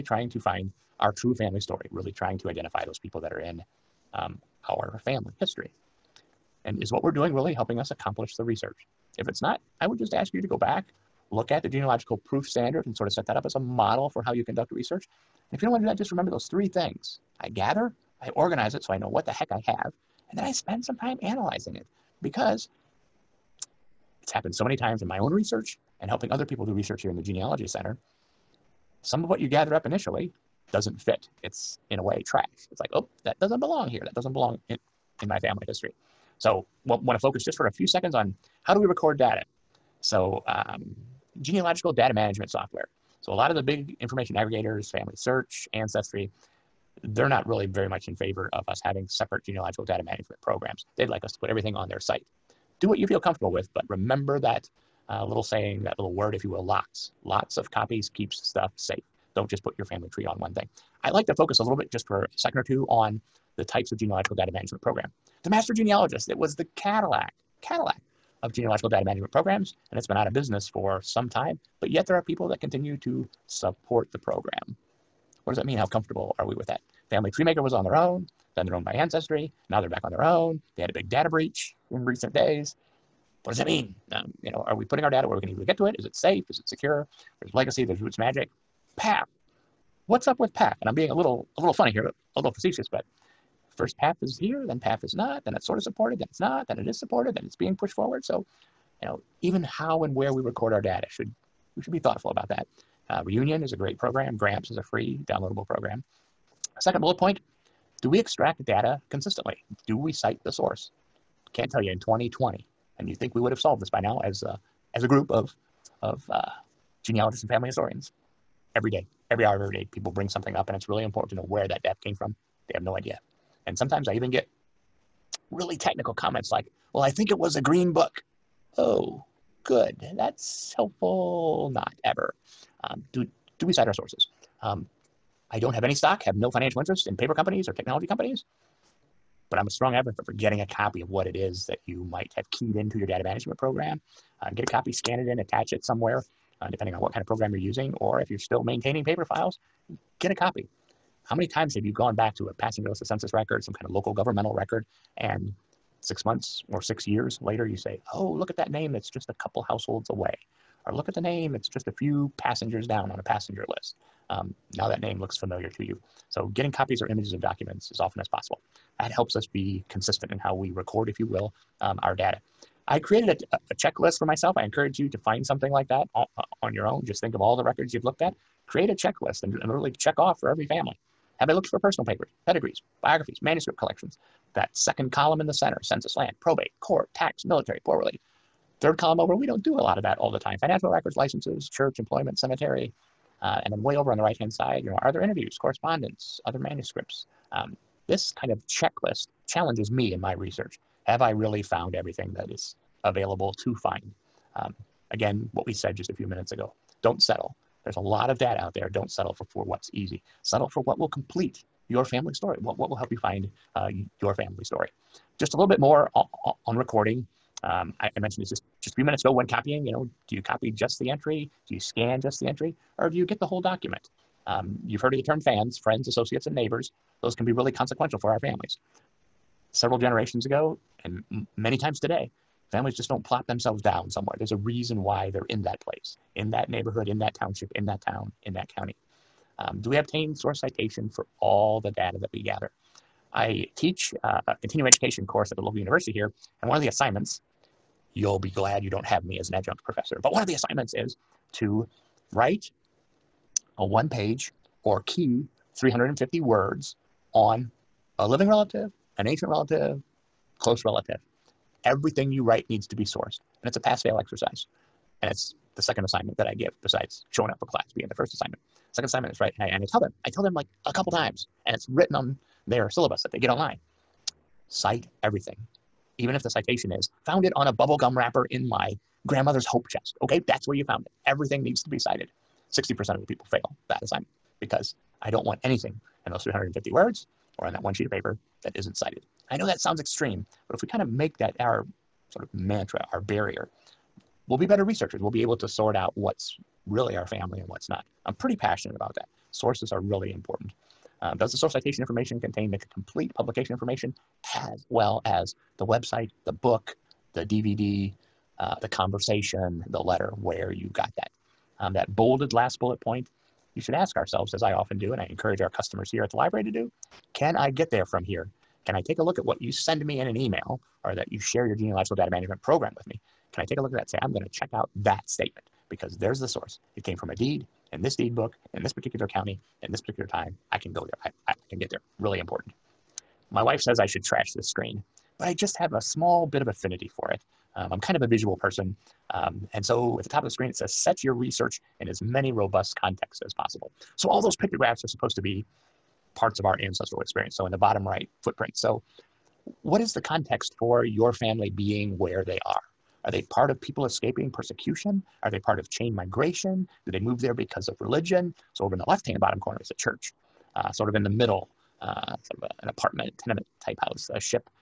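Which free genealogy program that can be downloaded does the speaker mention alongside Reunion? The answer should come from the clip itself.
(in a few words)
Gramps.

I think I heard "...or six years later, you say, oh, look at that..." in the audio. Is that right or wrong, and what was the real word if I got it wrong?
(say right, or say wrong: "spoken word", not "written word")
right.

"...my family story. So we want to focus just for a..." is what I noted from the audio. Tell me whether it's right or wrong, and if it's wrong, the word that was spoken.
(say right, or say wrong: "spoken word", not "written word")
wrong: "history", not "story".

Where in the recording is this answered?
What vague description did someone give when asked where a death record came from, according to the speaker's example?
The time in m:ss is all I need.
2:07.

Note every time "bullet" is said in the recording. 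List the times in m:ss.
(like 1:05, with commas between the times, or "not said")
1:47, 5:12.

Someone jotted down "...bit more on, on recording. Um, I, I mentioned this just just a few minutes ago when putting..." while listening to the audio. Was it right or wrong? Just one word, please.
wrong.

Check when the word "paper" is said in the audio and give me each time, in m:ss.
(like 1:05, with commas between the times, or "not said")
2:17, 2:29, 3:02, 4:48.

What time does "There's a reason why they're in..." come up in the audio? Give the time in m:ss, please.
3:54.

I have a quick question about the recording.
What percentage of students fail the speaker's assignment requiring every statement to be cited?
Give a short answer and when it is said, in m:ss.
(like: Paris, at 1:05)
60%, at 4:42.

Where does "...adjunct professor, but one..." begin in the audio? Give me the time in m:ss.
4:09.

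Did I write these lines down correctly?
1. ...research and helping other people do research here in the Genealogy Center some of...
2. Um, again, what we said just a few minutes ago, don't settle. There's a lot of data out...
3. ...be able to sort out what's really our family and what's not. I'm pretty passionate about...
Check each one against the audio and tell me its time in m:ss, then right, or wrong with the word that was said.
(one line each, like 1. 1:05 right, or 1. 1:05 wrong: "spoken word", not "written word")
1. 0:25 right
2. 3:24 right
3. 4:55 right.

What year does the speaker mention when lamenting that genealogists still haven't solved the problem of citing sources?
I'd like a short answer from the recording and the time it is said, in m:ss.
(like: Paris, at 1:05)
2020, at 1:51.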